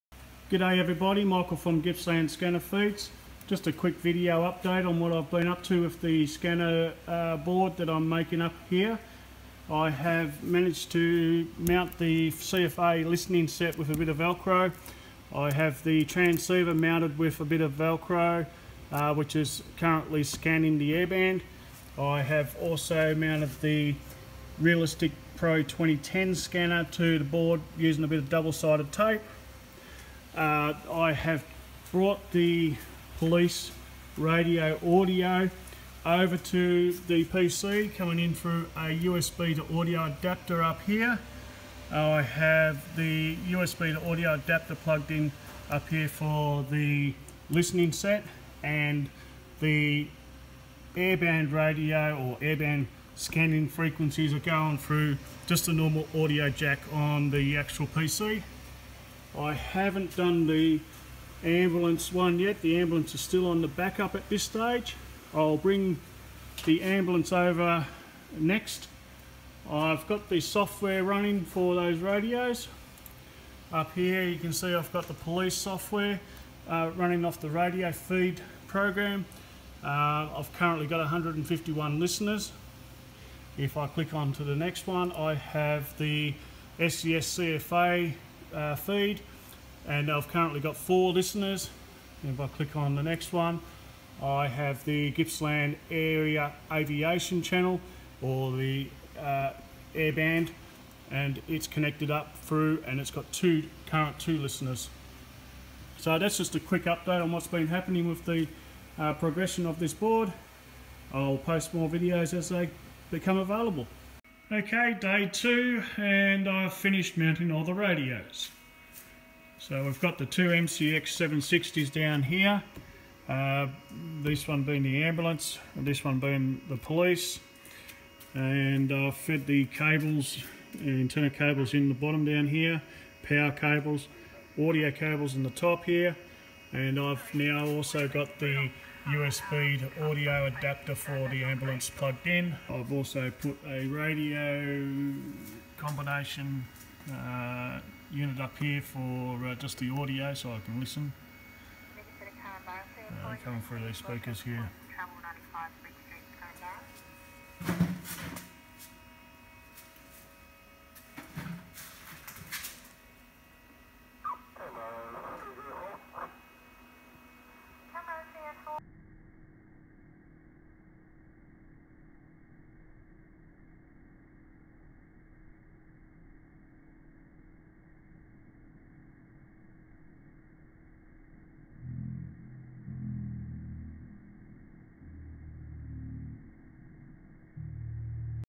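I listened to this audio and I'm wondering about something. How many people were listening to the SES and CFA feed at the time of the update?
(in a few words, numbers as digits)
4.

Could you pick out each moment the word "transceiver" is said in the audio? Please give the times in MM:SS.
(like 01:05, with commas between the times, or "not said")
00:16.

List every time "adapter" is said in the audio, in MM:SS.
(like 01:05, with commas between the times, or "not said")
00:40, 00:44, 02:20.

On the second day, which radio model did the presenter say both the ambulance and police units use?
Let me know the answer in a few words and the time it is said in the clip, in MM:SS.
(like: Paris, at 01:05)
MCX 760, at 02:00.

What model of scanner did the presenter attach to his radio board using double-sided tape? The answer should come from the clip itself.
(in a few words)
Realistic Pro 2010.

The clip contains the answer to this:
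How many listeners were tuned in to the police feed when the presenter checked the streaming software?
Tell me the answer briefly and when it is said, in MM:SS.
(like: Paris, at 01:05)
151, at 01:20.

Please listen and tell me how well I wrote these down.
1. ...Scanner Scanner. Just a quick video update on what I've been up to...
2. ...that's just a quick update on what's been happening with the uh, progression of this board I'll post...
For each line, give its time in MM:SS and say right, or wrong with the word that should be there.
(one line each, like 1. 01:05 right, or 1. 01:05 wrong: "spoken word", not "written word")
1. 00:02 wrong: "Feeds", not "Scanner"
2. 01:46 right.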